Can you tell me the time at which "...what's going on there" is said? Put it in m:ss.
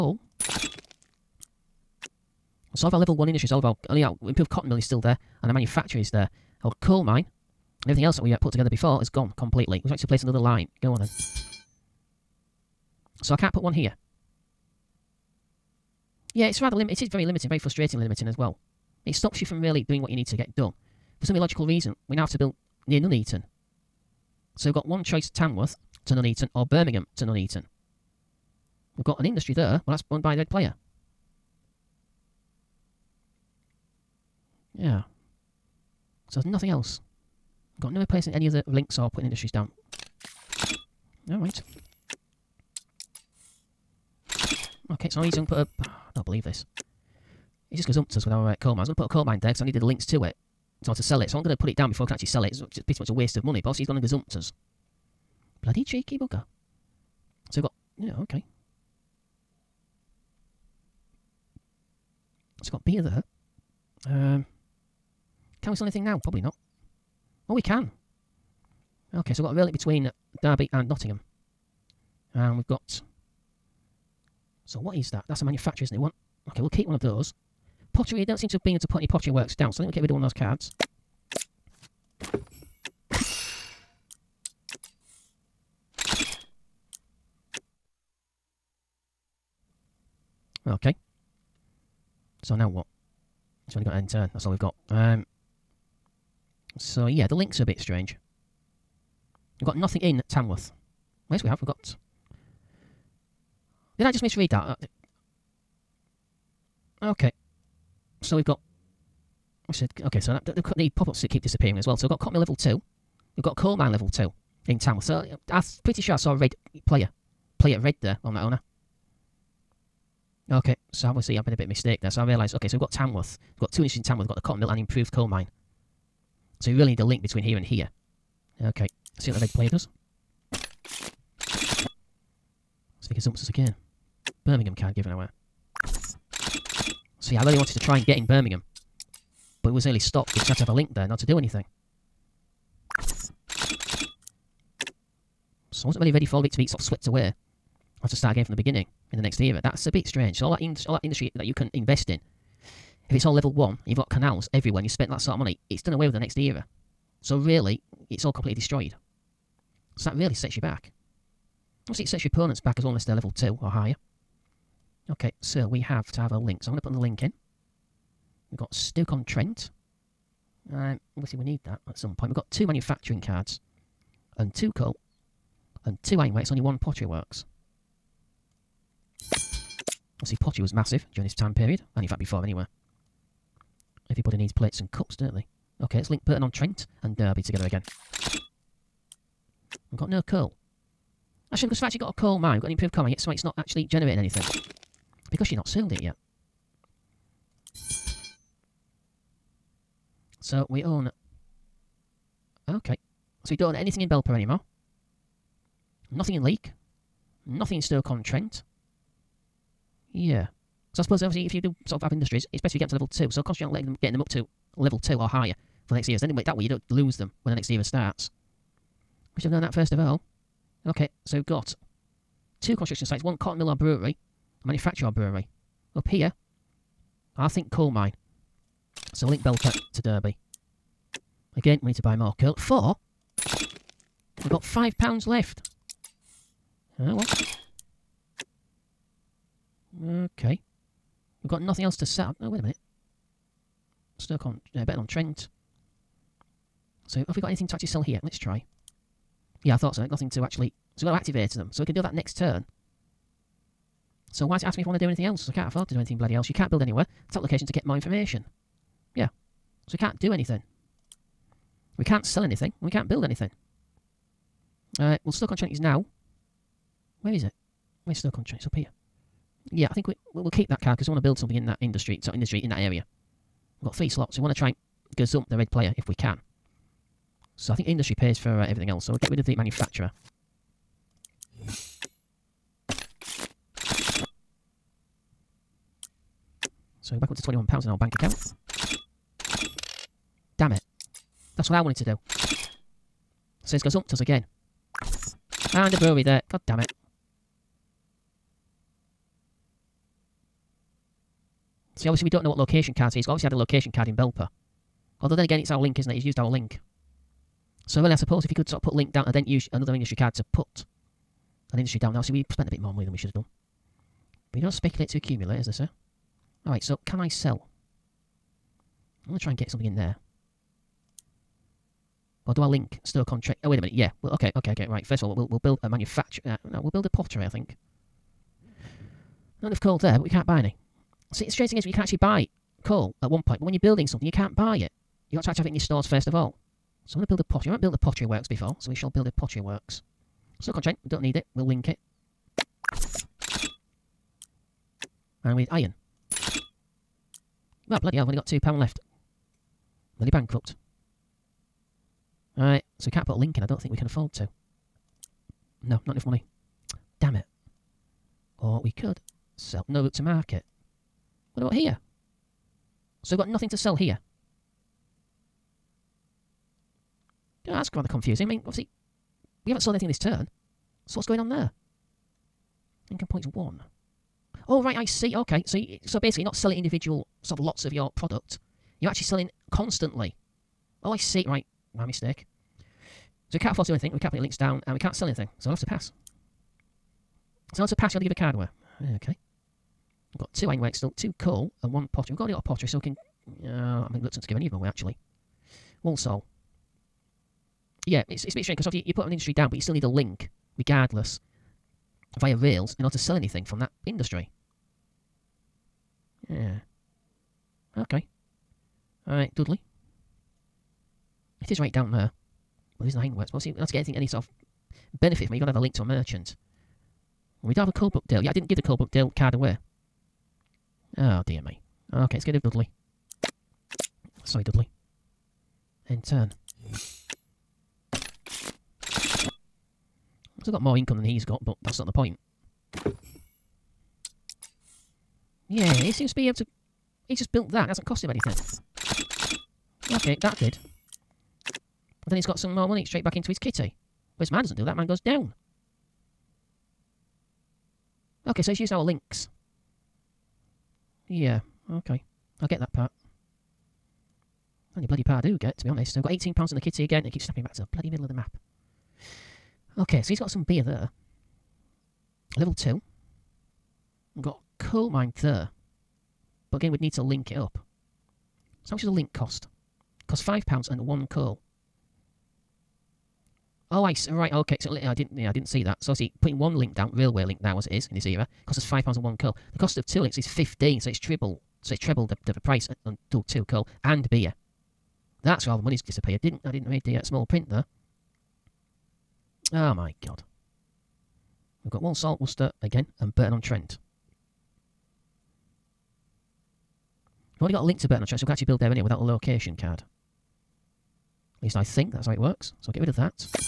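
6:11.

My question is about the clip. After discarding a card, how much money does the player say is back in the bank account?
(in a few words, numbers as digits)
£21.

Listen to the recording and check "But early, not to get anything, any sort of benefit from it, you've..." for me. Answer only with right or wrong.
wrong.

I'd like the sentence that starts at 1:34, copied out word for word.
Um, so yeah, the links are a bit strange.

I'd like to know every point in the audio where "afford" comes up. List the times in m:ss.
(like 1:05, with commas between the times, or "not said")
4:15, 5:54, 6:23.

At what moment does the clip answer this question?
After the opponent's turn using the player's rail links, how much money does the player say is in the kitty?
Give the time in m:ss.
7:36.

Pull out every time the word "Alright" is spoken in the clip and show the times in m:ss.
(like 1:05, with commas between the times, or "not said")
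0:41, 5:16, 5:52, 6:49.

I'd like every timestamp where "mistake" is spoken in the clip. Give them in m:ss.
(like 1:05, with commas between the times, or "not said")
2:01, 6:22.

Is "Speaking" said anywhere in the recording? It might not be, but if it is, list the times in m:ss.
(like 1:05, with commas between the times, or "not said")
2:13.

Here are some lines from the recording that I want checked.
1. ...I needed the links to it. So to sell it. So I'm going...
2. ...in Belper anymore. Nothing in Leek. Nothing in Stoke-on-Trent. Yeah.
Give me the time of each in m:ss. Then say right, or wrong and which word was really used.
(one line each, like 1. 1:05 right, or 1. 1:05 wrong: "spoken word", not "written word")
1. 0:49 right
2. 3:24 right.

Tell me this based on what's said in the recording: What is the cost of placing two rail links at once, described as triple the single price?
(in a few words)
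£15.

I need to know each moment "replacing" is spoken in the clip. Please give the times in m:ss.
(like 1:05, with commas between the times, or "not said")
0:37.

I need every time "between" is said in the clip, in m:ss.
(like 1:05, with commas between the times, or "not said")
1:09, 2:07.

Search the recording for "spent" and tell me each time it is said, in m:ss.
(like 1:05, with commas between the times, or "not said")
2:34, 5:12.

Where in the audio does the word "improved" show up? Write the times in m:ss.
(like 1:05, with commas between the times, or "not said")
0:04, 2:04, 3:12.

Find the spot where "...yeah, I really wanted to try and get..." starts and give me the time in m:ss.
2:17.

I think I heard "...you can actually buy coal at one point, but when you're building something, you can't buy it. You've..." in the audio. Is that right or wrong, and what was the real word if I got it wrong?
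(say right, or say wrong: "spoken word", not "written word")
right.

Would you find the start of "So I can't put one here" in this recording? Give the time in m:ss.
0:13.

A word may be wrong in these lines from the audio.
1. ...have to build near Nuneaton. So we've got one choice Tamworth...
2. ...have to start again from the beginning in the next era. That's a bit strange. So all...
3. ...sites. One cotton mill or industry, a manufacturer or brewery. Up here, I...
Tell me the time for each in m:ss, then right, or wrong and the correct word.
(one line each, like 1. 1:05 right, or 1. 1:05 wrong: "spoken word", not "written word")
1. 0:22 right
2. 2:28 right
3. 3:43 wrong: "brewery", not "industry".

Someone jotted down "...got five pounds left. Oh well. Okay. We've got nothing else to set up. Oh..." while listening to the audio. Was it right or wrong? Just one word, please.
right.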